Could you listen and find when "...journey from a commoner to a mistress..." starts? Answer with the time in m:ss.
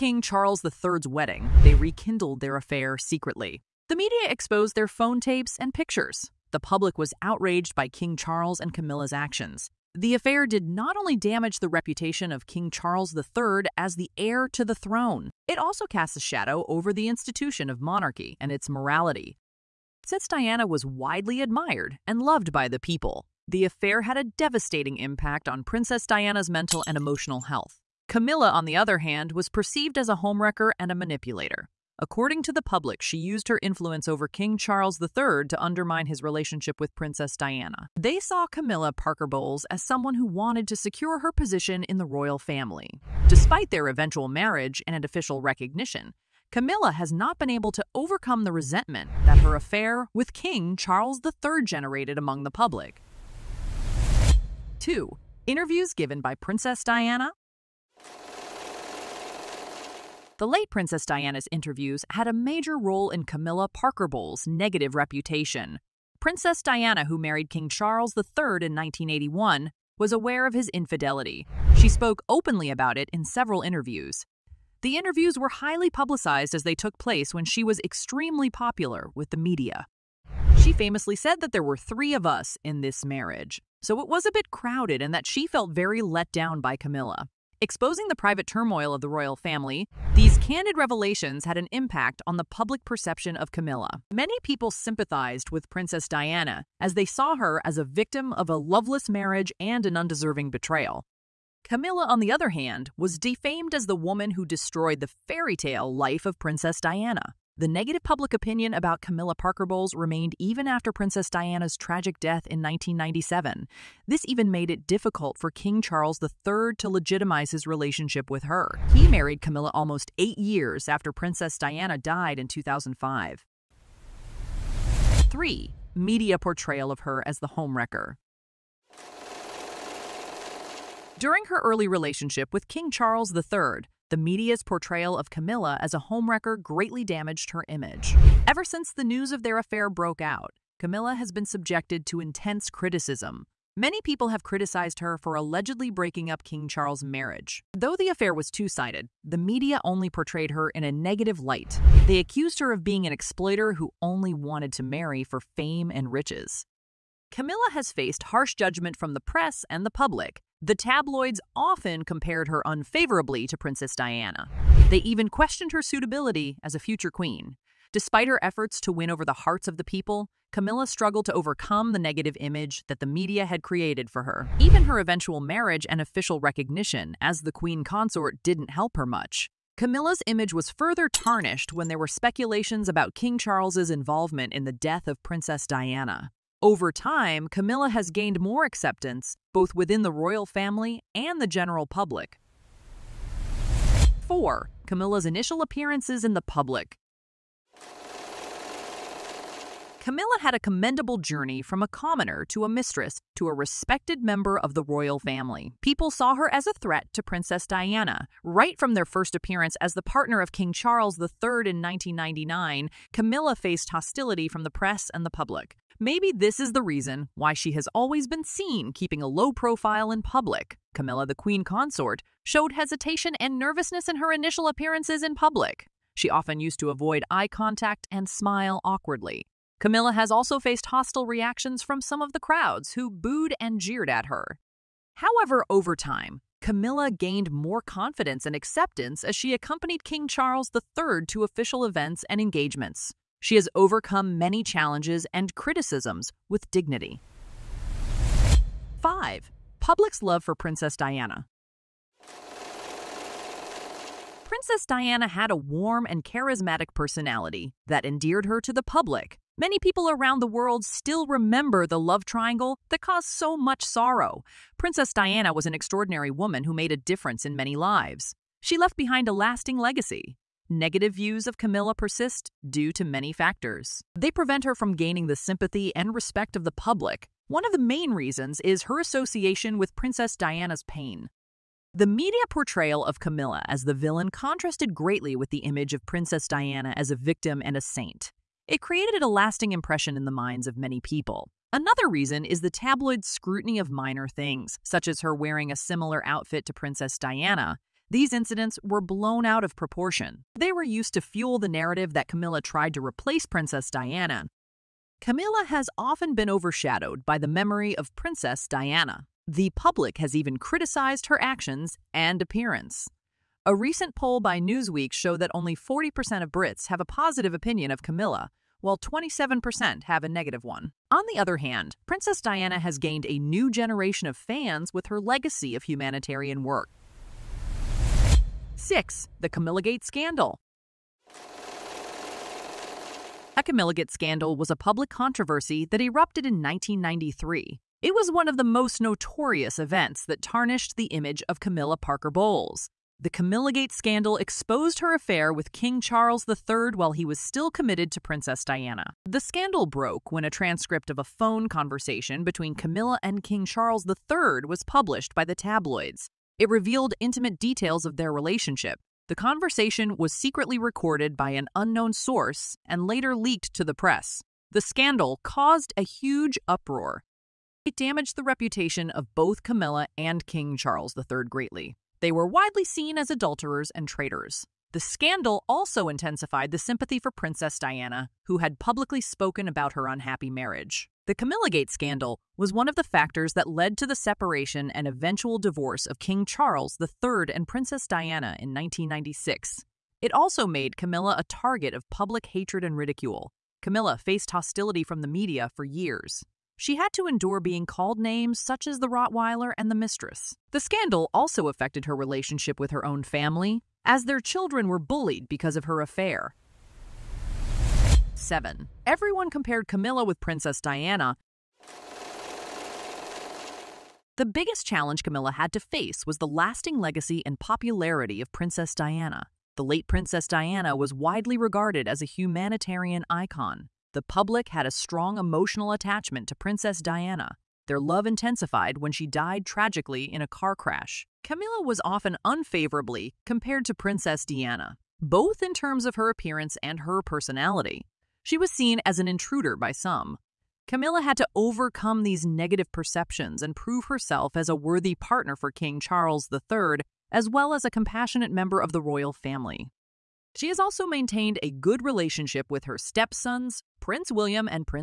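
3:21.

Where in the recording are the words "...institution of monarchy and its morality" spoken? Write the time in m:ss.
0:17.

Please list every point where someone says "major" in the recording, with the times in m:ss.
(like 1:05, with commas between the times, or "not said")
1:02.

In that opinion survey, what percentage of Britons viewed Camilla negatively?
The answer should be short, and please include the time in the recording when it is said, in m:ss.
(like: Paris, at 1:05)
27%, at 5:18.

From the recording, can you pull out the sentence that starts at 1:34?
Many people sympathized with Princess Diana as they saw her as a victim of a loveless marriage and an undeserving betrayal.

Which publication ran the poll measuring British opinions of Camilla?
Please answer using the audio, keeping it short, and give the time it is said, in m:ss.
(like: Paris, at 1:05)
Newsweek, at 5:14.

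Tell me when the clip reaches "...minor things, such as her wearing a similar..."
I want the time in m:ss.
4:53.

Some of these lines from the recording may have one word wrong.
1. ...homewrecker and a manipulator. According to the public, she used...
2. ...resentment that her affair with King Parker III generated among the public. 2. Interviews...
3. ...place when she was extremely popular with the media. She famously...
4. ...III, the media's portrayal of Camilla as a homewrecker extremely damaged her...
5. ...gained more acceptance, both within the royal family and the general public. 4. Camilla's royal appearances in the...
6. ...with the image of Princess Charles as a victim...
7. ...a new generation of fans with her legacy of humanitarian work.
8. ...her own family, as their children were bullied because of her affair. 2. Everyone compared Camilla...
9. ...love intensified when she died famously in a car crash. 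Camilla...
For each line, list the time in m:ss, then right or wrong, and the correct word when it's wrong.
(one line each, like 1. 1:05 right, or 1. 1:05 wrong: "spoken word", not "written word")
1. 0:30 right
2. 0:48 wrong: "Charles", not "Parker"
3. 1:16 right
4. 2:13 wrong: "greatly", not "extremely"
5. 3:08 wrong: "initial", not "royal"
6. 4:45 wrong: "Diana", not "Charles"
7. 5:23 right
8. 6:42 wrong: "7", not "2"
9. 7:07 wrong: "tragically", not "famously".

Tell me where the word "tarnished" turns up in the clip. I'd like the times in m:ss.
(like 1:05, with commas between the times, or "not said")
3:01, 5:40.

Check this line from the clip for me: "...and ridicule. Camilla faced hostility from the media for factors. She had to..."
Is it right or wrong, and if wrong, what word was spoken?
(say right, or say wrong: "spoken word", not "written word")
wrong: "years", not "factors".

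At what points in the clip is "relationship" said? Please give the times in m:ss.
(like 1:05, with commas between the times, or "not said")
0:36, 1:57, 2:11, 5:58, 6:42, 7:32.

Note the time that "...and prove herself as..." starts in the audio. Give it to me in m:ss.
7:23.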